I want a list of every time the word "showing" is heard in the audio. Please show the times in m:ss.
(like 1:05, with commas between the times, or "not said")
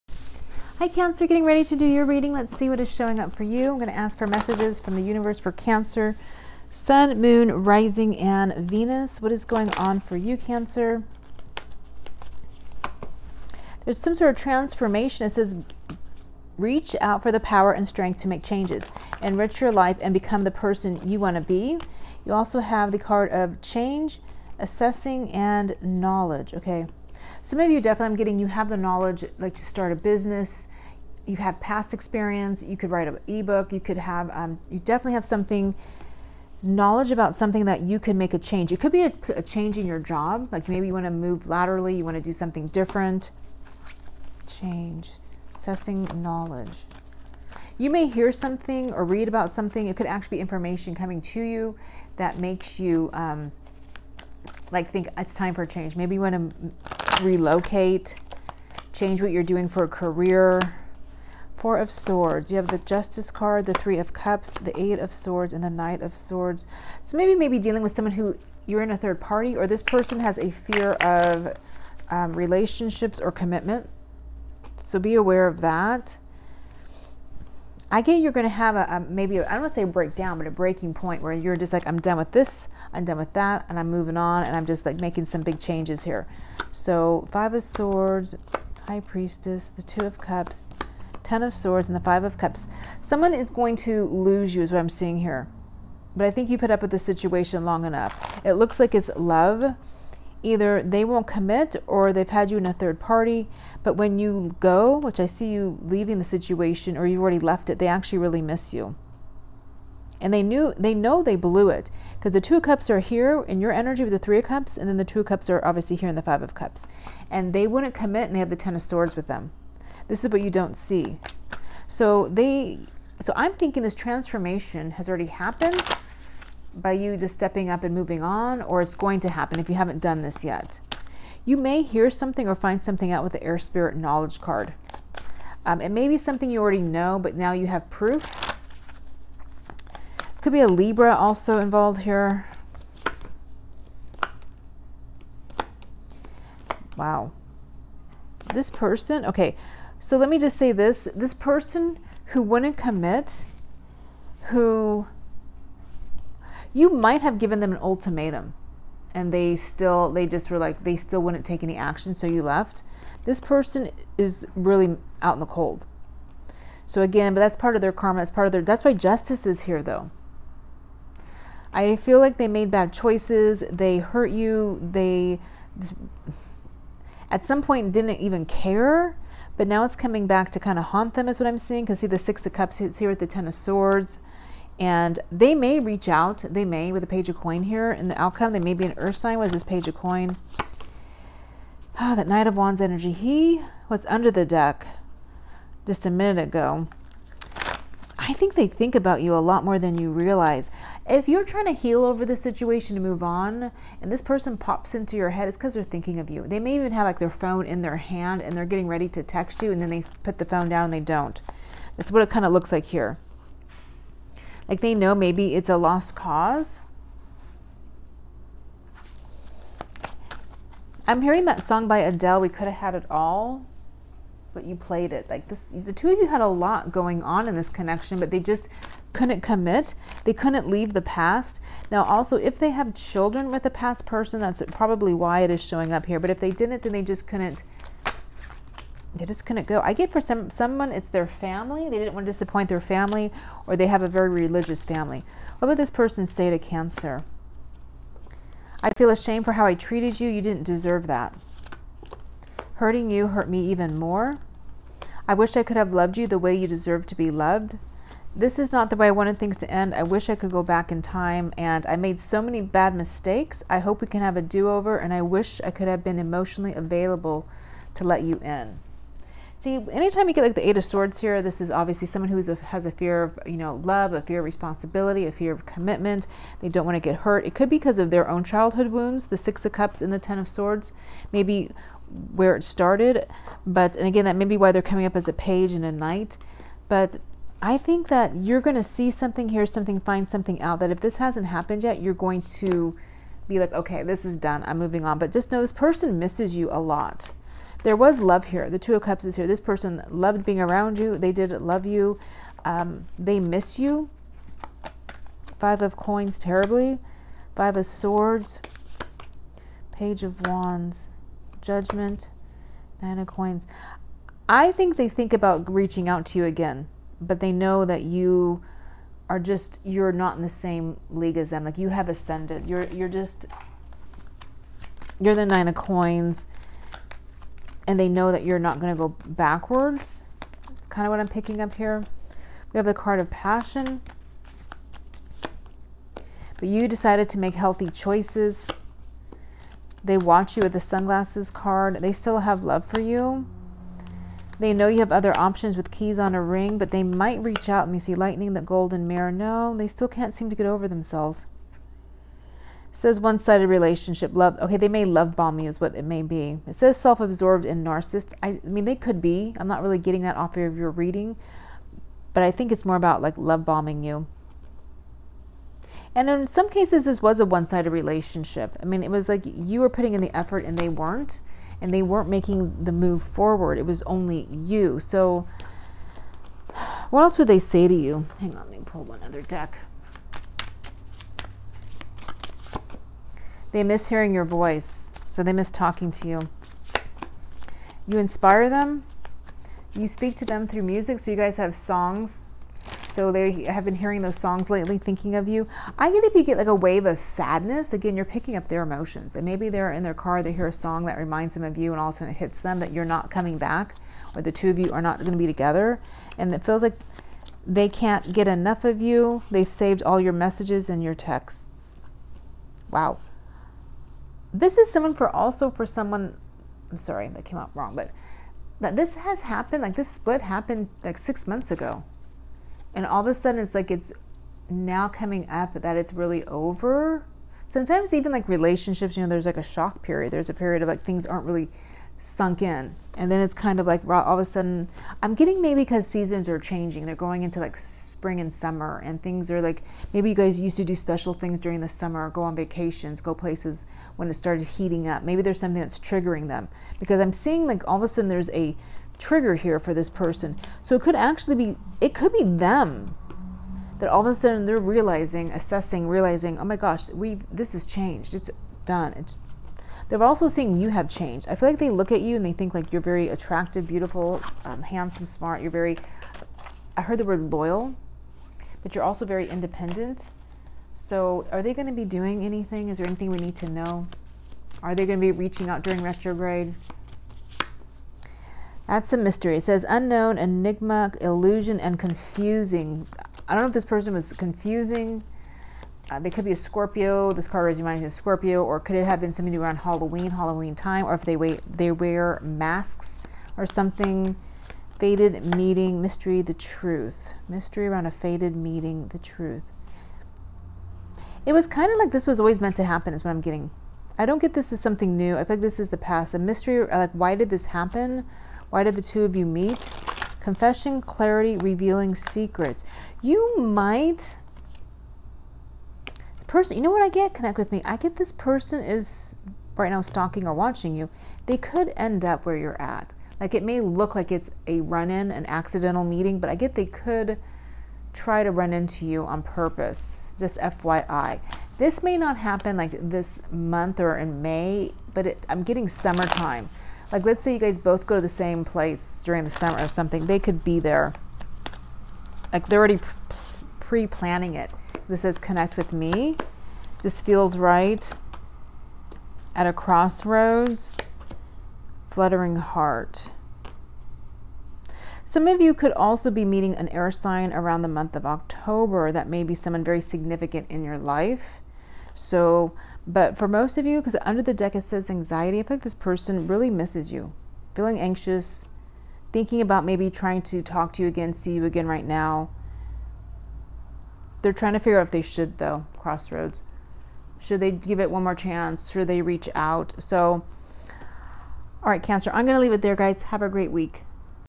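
0:02, 3:55.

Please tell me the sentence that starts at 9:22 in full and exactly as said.
So but for most of you, because under the deck it says anxiety, I feel like this person really misses you.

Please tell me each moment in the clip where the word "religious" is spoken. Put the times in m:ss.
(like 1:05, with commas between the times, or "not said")
4:04.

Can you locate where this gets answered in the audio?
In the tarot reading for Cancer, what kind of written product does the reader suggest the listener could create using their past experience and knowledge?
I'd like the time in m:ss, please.
0:33.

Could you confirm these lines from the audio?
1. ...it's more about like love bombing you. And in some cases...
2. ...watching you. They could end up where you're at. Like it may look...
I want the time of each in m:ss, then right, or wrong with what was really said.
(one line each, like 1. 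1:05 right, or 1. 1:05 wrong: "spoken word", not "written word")
1. 6:02 right
2. 8:40 right.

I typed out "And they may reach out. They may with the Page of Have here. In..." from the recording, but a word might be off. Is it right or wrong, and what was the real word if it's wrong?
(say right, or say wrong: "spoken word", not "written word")
wrong: "Coin", not "Have".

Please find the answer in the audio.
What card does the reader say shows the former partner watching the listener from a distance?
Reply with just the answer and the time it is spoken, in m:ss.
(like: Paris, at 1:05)
sunglasses card, at 5:40.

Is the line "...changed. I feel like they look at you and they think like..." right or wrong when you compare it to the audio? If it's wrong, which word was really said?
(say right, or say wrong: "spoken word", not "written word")
right.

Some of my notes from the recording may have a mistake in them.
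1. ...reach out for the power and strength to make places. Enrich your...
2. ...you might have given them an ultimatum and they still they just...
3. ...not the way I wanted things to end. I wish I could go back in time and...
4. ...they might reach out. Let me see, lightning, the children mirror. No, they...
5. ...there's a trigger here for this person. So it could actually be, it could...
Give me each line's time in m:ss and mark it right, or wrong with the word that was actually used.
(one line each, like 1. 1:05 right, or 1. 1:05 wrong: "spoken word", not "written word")
1. 0:16 wrong: "changes", not "places"
2. 2:36 right
3. 4:18 right
4. 5:46 wrong: "golden", not "children"
5. 7:28 right.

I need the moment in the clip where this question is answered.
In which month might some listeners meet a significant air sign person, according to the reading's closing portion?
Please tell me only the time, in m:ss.
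9:18.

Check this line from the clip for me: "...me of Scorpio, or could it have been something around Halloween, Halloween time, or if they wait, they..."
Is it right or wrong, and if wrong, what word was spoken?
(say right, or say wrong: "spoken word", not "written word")
right.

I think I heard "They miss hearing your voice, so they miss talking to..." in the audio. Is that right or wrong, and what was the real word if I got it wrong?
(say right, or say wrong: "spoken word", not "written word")
right.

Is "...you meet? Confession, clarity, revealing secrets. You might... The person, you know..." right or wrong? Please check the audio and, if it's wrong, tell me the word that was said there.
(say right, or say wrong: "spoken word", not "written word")
right.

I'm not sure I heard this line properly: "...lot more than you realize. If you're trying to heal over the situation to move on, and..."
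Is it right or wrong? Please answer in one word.
right.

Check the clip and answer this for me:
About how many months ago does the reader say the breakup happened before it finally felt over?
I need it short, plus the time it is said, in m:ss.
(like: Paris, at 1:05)
6 months, at 7:01.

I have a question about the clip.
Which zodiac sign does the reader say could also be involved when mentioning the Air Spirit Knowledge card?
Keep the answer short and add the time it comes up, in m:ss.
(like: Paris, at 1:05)
Libra, at 2:20.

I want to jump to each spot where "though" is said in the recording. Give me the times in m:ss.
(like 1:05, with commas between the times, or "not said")
2:49, 9:35.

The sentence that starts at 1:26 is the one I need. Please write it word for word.
So Five of Swords, High Priestess, the Two of Cups, Ten of Swords and the Five of Cups.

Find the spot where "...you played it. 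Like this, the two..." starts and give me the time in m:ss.
3:44.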